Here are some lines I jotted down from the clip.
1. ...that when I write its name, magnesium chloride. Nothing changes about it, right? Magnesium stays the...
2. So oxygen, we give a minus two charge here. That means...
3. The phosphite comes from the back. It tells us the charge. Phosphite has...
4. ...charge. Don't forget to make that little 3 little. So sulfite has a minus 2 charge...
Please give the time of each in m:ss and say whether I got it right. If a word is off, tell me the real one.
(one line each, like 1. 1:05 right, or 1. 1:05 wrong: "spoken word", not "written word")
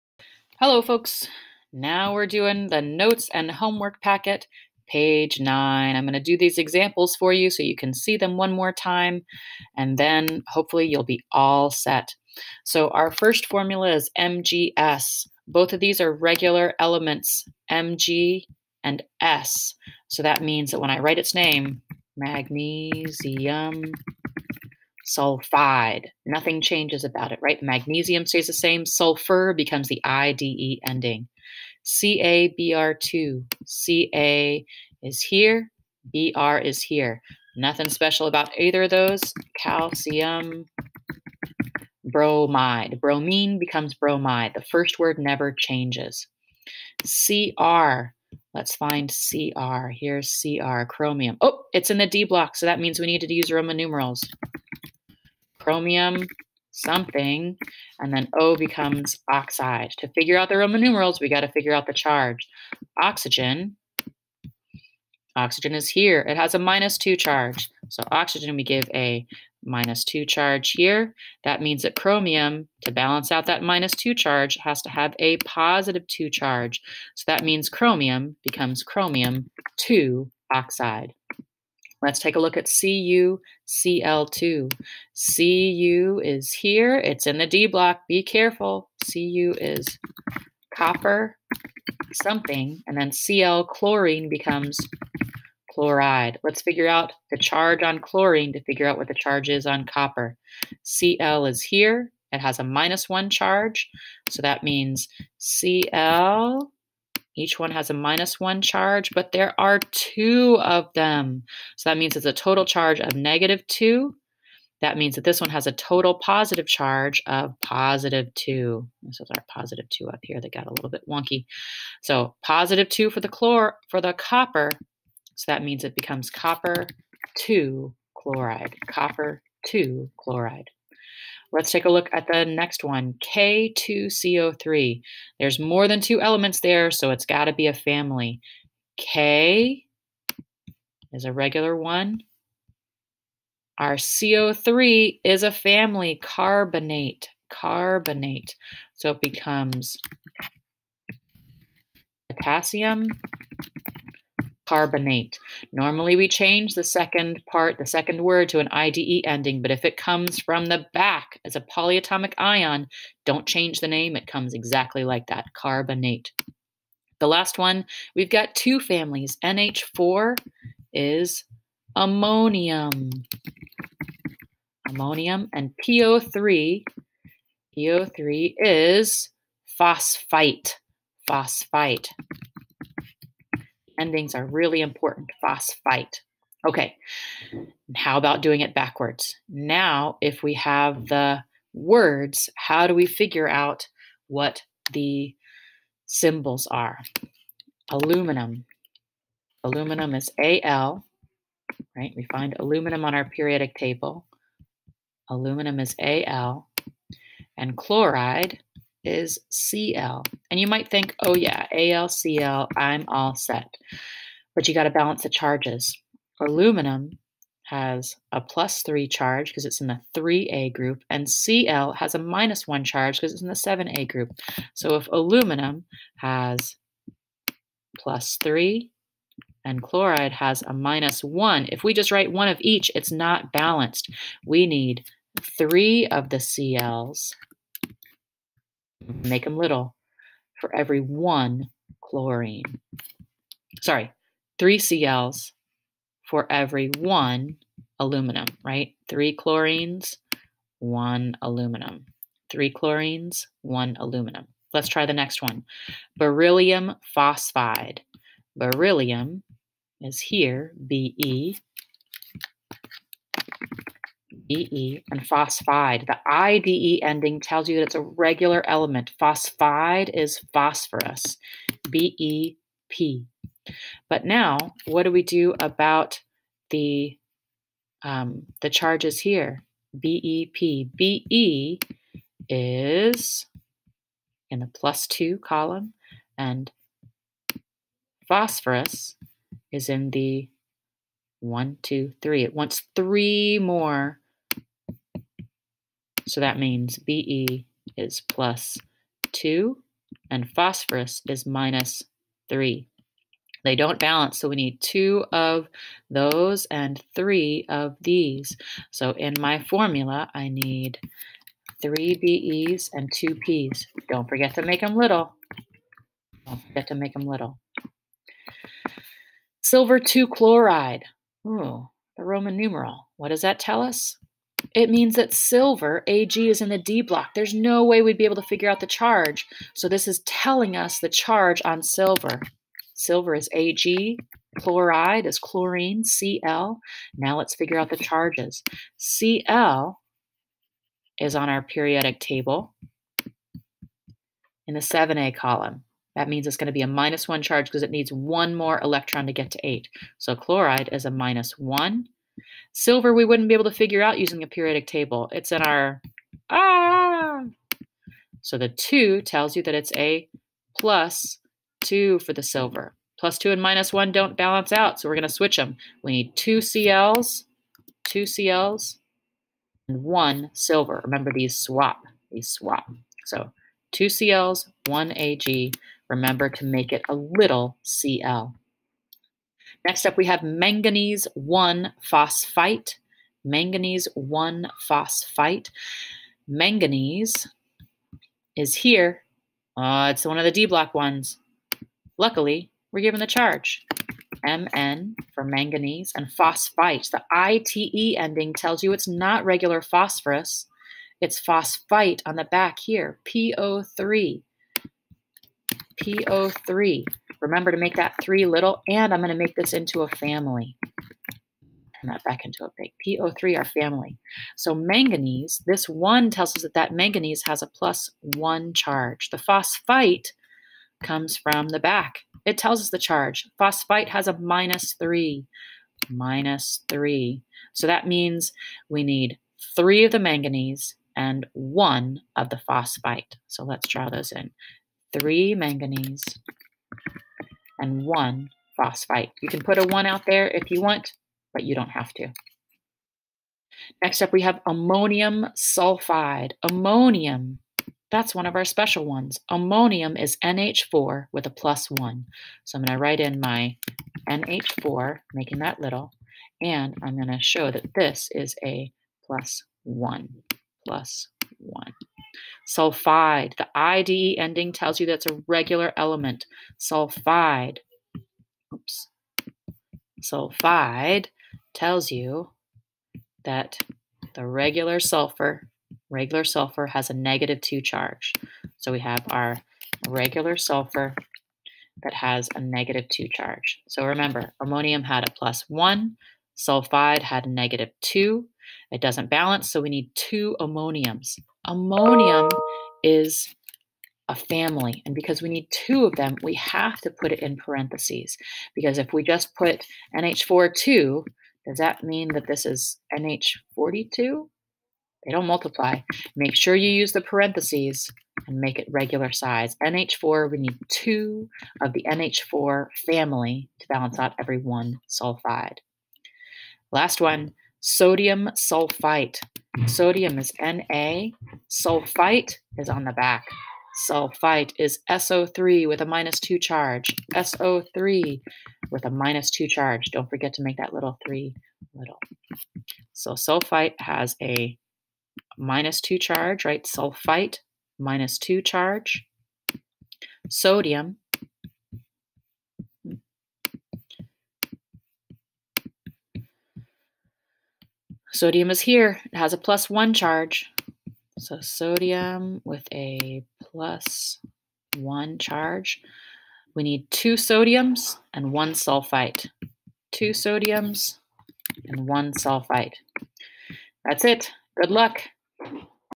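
1. 0:20 wrong: "sulfide", not "chloride"
2. 1:07 right
3. 6:59 right
4. 8:49 right.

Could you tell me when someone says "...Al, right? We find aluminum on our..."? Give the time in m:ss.
3:20.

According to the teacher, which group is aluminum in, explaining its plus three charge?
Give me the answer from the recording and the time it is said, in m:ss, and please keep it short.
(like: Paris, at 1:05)
3A, at 3:40.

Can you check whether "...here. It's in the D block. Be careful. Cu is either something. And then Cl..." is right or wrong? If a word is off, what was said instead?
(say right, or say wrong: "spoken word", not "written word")
wrong: "copper", not "either".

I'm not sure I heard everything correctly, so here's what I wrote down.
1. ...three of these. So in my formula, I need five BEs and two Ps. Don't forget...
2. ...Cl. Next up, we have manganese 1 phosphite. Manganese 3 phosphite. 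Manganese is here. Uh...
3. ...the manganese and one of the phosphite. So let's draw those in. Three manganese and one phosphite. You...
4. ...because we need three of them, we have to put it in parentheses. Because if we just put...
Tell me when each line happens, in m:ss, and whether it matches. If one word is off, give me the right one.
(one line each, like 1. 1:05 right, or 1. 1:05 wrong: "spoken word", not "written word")
1. 5:07 wrong: "three", not "five"
2. 6:17 wrong: "1", not "3"
3. 7:10 right
4. 8:15 wrong: "two", not "three".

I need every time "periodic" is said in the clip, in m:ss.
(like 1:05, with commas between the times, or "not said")
3:23, 5:41, 5:54.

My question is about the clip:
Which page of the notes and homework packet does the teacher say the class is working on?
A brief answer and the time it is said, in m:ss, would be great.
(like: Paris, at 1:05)
9, at 0:04.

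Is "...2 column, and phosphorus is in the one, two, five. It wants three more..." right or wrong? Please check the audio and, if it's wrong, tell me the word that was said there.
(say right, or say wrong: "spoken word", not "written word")
wrong: "three", not "five".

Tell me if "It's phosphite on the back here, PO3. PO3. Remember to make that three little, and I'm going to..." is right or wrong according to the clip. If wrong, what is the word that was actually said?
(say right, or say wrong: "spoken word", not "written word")
right.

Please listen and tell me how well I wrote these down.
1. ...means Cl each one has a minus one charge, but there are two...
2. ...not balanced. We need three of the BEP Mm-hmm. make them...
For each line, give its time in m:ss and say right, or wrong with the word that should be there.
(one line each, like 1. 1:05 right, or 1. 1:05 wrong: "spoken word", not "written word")
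1. 1:44 right
2. 3:53 wrong: "Cls", not "BEP".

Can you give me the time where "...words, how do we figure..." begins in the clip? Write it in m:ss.
3:11.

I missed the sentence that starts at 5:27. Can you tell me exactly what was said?
There's no way we'd be able to figure out the charge.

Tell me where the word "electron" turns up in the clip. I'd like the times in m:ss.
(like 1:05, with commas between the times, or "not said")
5:48.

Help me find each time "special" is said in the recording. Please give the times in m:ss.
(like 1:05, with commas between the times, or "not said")
0:37, 7:28.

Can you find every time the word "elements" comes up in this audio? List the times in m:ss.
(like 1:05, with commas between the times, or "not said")
0:16, 2:16, 4:28, 7:45.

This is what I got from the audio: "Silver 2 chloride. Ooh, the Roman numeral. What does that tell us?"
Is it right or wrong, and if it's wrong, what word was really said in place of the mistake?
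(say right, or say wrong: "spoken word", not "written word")
right.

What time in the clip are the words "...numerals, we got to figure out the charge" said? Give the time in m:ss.
1:00.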